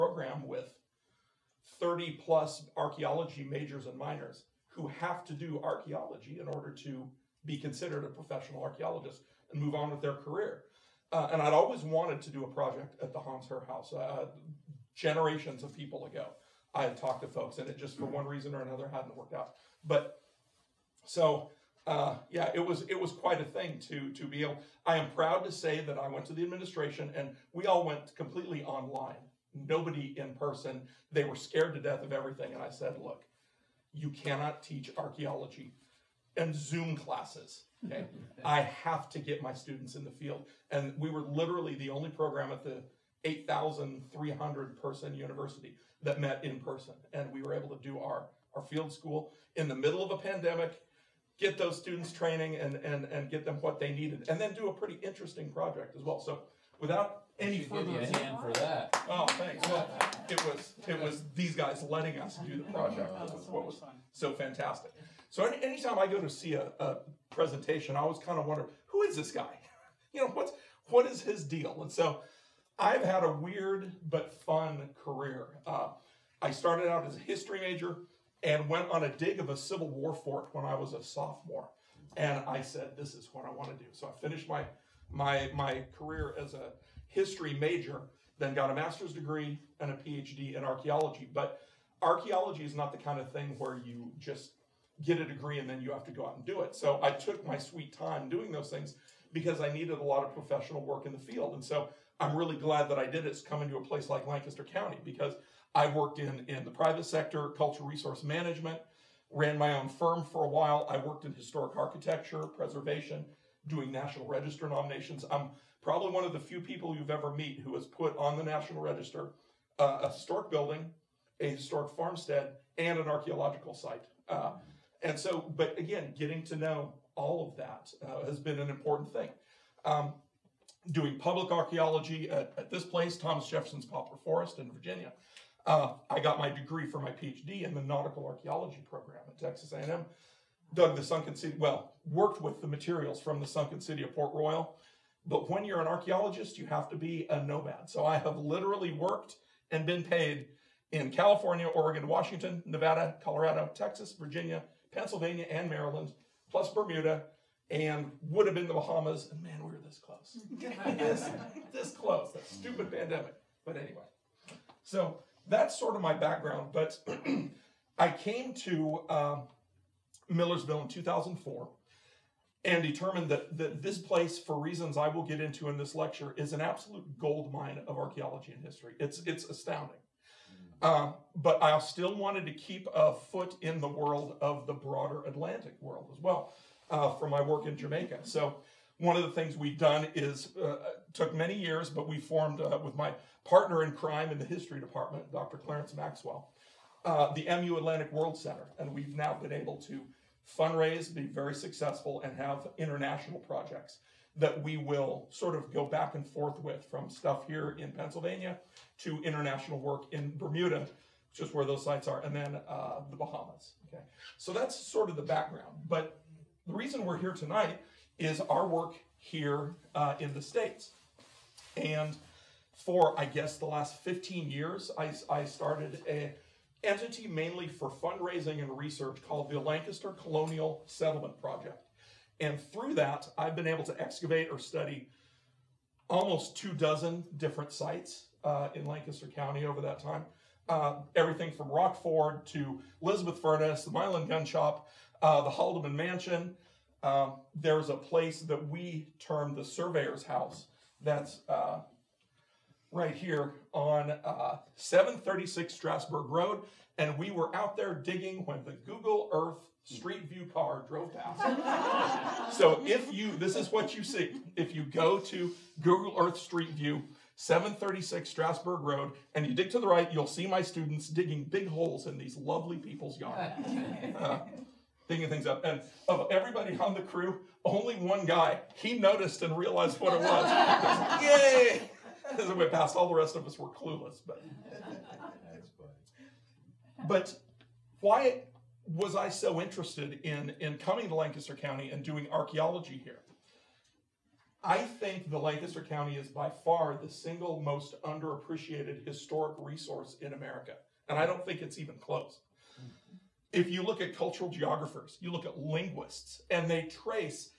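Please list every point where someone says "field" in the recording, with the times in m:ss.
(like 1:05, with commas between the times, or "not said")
0:40, 0:48, 1:41.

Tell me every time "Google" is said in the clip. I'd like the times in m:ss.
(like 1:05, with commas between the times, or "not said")
4:18, 4:25.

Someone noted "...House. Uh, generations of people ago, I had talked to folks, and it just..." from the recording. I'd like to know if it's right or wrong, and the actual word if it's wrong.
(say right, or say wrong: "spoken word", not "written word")
right.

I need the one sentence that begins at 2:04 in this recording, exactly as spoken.
Uh, and so, but again, getting to know all of that uh, has been an important thing.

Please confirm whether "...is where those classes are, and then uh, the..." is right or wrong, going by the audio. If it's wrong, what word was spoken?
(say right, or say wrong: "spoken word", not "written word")
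wrong: "sites", not "classes".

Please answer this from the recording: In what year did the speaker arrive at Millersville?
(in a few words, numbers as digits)
2004.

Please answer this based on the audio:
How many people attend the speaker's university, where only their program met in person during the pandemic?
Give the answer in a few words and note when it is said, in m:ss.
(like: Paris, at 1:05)
8,300, at 0:43.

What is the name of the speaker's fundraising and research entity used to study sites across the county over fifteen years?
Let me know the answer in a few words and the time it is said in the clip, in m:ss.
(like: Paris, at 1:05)
Lancaster Colonial Settlement Project, at 3:49.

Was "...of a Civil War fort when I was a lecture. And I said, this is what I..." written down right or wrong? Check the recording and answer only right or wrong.
wrong.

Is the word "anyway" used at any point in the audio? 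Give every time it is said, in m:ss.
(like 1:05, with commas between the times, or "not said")
2:43.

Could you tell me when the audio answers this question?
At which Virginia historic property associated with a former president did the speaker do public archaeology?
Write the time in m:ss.
2:13.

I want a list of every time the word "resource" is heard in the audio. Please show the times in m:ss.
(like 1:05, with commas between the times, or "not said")
1:47, 4:59.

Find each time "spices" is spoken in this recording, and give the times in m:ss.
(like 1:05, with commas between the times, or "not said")
not said.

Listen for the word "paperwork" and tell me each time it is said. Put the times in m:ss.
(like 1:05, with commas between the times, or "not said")
not said.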